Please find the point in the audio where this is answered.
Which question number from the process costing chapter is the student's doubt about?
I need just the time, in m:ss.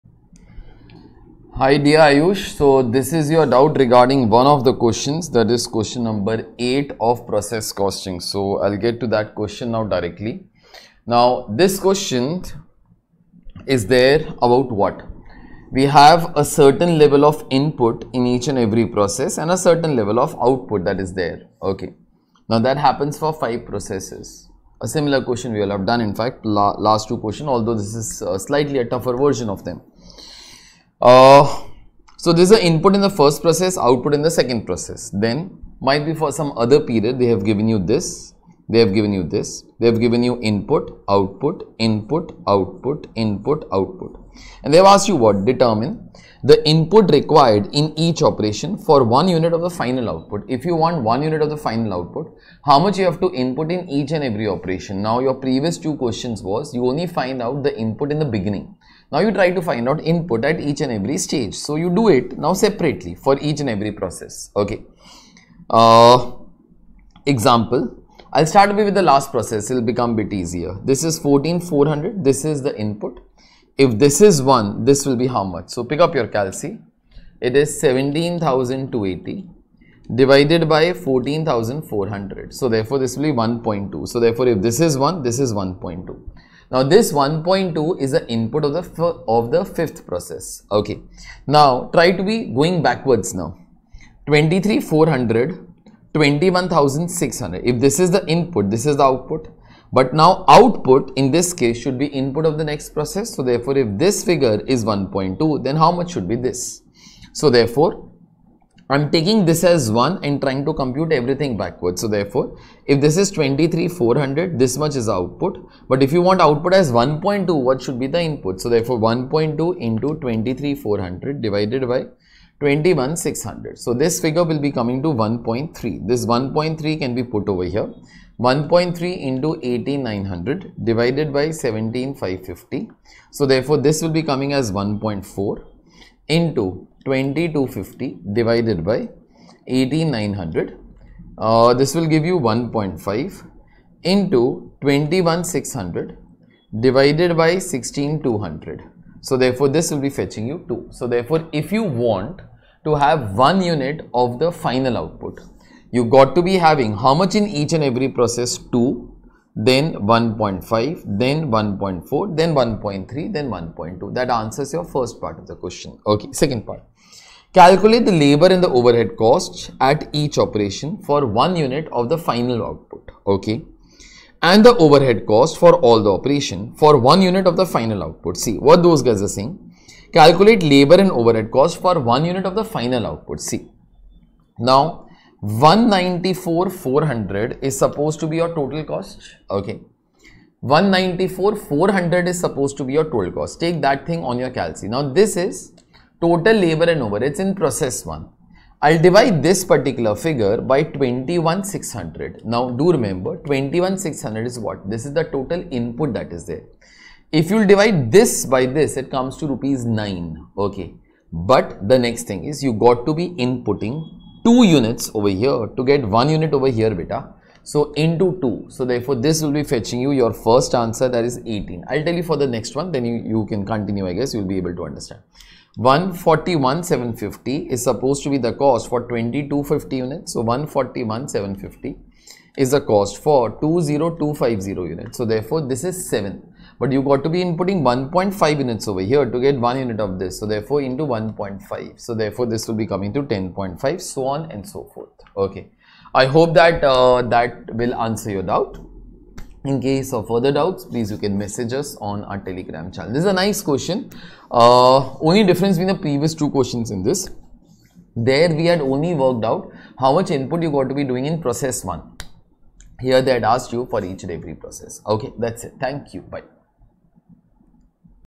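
0:05.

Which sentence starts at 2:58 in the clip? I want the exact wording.
See what those guys are saying Calculate labor and overhead cost for one unit of the final output.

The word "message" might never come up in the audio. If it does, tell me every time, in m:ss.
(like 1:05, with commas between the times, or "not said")
4:11.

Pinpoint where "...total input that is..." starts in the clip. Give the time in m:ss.
3:25.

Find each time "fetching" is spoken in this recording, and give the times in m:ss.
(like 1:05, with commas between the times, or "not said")
2:30, 3:39.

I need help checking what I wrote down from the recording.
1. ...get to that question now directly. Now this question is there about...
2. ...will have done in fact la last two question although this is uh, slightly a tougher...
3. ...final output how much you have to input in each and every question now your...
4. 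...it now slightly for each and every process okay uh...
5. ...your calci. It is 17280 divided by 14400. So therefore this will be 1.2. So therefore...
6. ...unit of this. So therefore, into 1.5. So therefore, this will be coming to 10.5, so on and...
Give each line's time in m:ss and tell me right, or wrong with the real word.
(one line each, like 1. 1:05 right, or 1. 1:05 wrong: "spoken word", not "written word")
1. 0:08 right
2. 0:25 right
3. 0:51 wrong: "operation", not "question"
4. 1:02 wrong: "separately", not "slightly"
5. 1:16 right
6. 3:59 right.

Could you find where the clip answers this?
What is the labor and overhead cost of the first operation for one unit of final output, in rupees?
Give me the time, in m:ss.
3:41.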